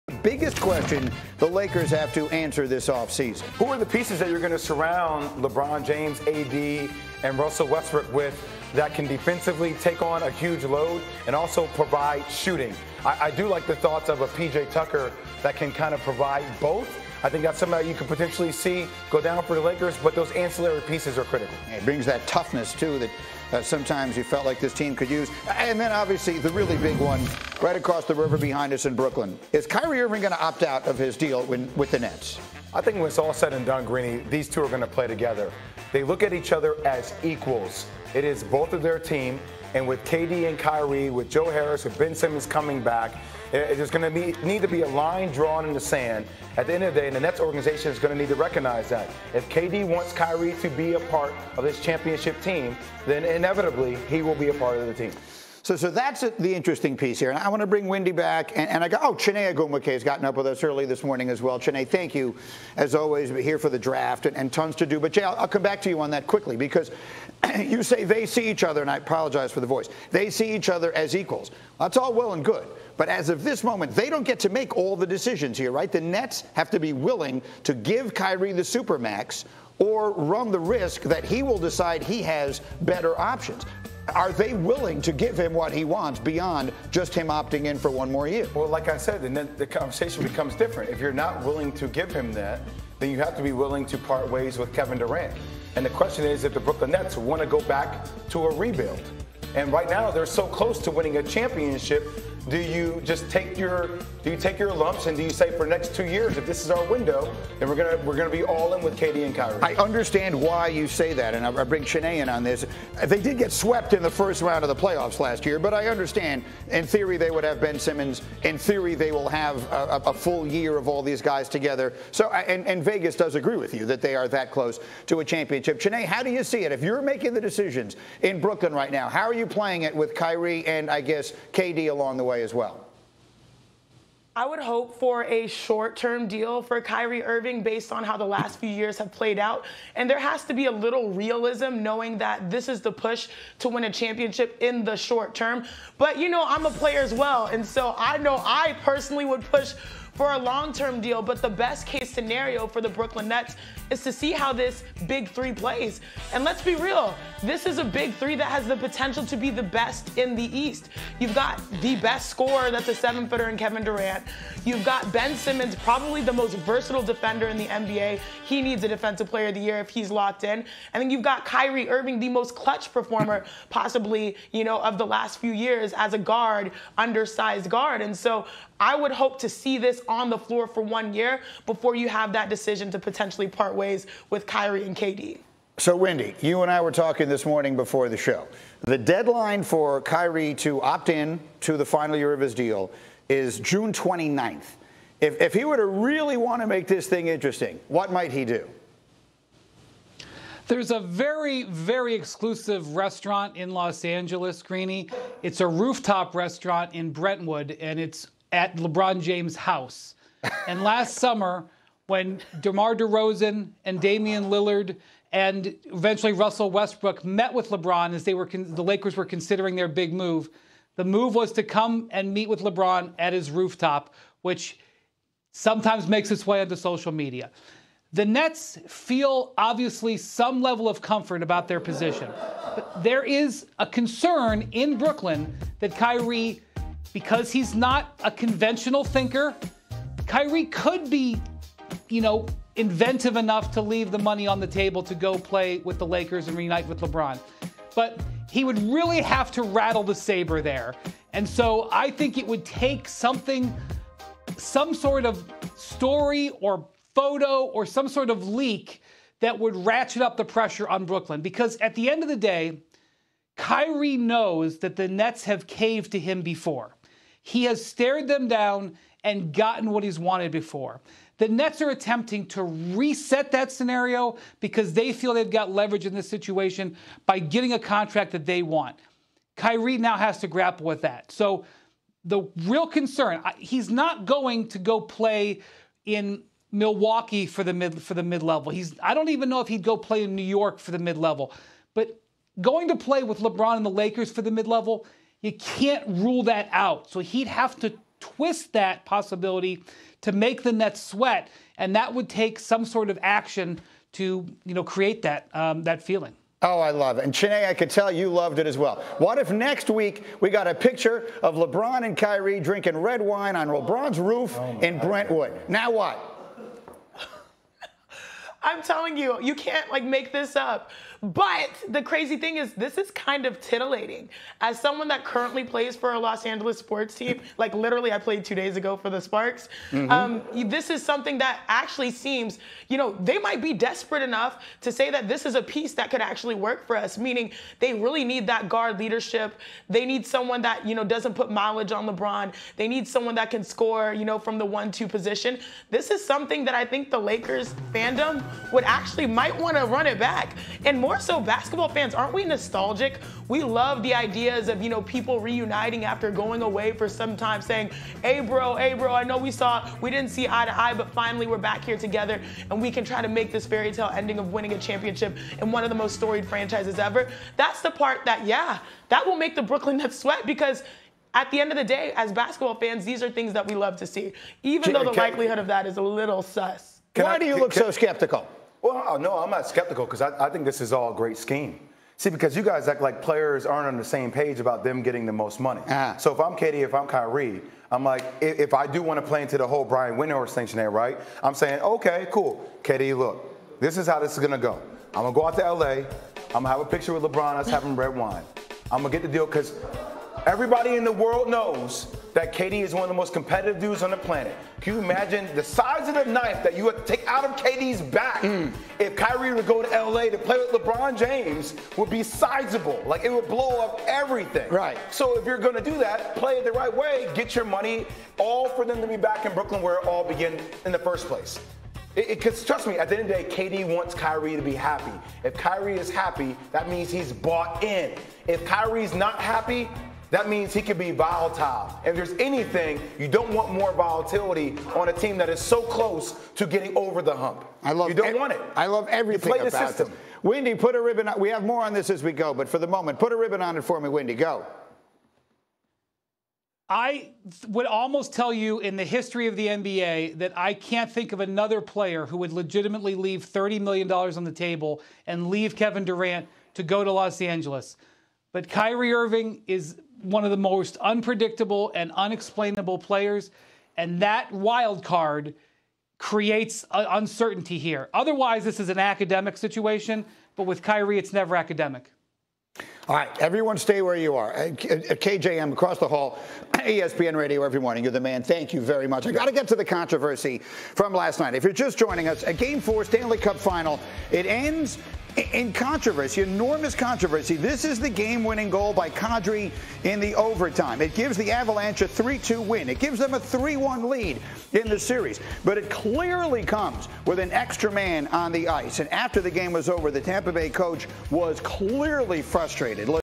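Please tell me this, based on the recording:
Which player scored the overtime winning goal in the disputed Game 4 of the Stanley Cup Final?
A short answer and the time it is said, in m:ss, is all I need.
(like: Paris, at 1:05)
Kadri, at 8:09.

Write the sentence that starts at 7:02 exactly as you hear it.
Because trust me, at the end of the day, KD wants Kyrie to be happy.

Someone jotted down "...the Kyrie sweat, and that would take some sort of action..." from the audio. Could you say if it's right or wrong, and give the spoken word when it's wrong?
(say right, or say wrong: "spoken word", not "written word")
wrong: "Nets", not "Kyrie".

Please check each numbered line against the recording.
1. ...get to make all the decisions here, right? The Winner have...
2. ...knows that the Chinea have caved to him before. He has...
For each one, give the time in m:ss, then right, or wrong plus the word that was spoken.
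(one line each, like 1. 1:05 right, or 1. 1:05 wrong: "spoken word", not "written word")
1. 1:14 wrong: "Nets", not "Winner"
2. 4:24 wrong: "Nets", not "Chinea".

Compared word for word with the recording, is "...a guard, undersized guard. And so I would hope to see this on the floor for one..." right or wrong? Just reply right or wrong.
right.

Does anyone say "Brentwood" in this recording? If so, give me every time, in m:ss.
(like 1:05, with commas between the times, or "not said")
3:27, 5:14.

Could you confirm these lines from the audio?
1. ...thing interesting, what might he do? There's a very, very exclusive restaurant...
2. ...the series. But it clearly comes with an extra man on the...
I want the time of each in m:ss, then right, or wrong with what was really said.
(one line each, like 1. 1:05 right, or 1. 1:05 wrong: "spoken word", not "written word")
1. 3:17 right
2. 8:14 right.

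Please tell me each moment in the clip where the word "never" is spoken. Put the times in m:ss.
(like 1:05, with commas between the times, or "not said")
7:51.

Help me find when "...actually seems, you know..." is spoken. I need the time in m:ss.
5:31.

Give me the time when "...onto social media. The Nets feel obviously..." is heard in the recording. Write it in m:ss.
3:46.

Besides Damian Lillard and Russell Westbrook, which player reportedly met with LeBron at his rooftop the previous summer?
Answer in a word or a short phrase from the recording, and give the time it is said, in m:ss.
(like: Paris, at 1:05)
DeMar DeRozan, at 3:32.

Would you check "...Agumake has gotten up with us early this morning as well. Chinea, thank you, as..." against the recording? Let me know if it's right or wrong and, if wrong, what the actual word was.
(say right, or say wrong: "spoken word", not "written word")
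right.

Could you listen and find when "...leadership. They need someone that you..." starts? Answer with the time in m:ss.
5:38.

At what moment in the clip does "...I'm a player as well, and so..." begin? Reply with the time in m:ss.
2:26.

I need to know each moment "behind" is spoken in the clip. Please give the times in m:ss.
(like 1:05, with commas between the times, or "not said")
0:28.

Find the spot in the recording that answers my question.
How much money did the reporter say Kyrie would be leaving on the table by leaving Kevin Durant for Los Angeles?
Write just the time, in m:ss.
7:33.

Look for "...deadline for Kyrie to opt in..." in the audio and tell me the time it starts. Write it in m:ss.
3:08.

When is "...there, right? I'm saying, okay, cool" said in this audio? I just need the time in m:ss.
6:30.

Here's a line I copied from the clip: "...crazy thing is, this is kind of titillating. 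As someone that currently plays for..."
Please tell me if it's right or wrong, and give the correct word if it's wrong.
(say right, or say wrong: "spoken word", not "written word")
right.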